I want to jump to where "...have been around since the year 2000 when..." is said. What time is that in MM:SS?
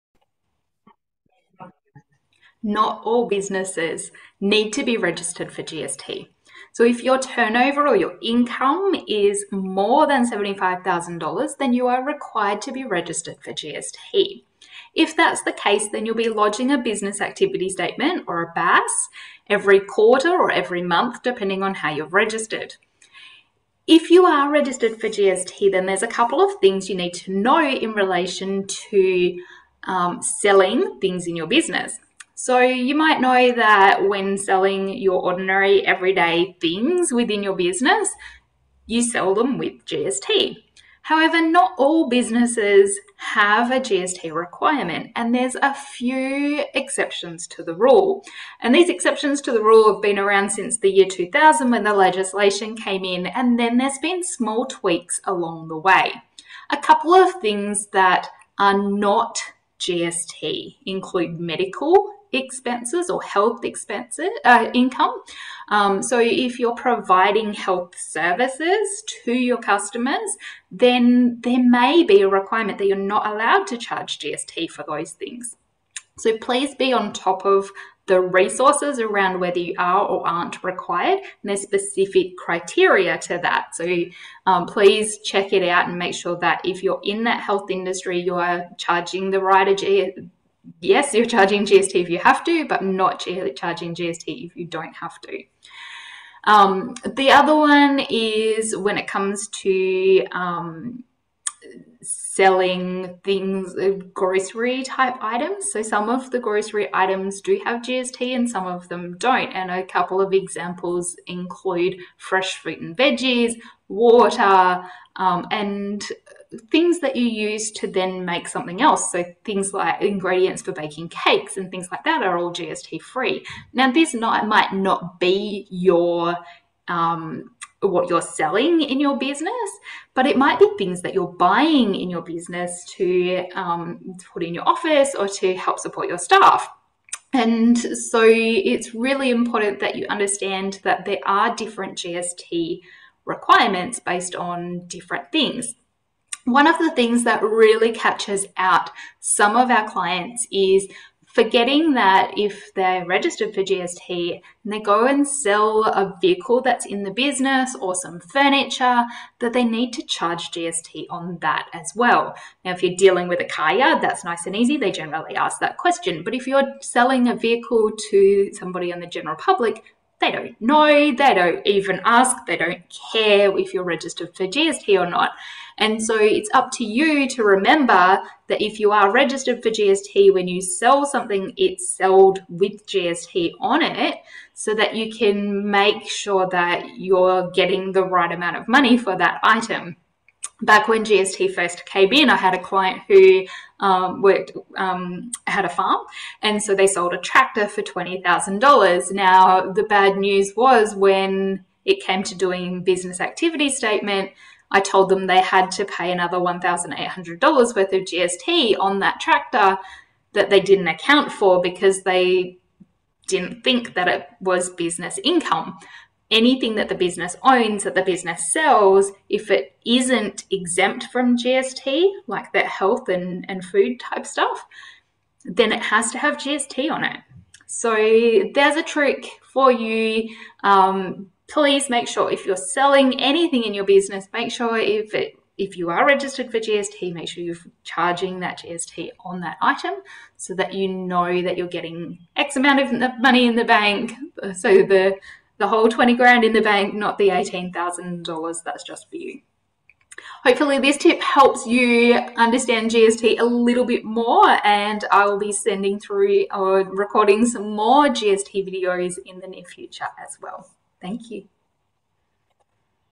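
00:49.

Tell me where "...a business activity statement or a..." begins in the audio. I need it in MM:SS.
00:16.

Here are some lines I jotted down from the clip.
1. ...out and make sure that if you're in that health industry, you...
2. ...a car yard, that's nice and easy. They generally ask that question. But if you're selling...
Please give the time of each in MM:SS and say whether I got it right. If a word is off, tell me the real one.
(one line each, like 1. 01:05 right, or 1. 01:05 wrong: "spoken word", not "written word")
1. 01:25 right
2. 02:43 right.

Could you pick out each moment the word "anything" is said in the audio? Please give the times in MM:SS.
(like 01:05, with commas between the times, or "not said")
03:36, 03:53.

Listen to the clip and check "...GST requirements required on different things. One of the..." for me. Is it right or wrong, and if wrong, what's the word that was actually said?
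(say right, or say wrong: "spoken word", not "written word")
wrong: "based", not "required".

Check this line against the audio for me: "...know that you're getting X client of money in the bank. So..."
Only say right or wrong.
wrong.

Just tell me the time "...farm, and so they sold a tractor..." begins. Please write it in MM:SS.
03:15.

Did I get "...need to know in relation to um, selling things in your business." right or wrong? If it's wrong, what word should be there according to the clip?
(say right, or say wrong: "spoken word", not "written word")
right.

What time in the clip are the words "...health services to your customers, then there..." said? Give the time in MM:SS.
01:07.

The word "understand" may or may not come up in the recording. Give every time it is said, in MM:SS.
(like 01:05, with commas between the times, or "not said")
02:20, 04:12.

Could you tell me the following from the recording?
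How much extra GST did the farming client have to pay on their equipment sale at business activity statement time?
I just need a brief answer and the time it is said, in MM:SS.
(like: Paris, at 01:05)
$1,800, at 03:26.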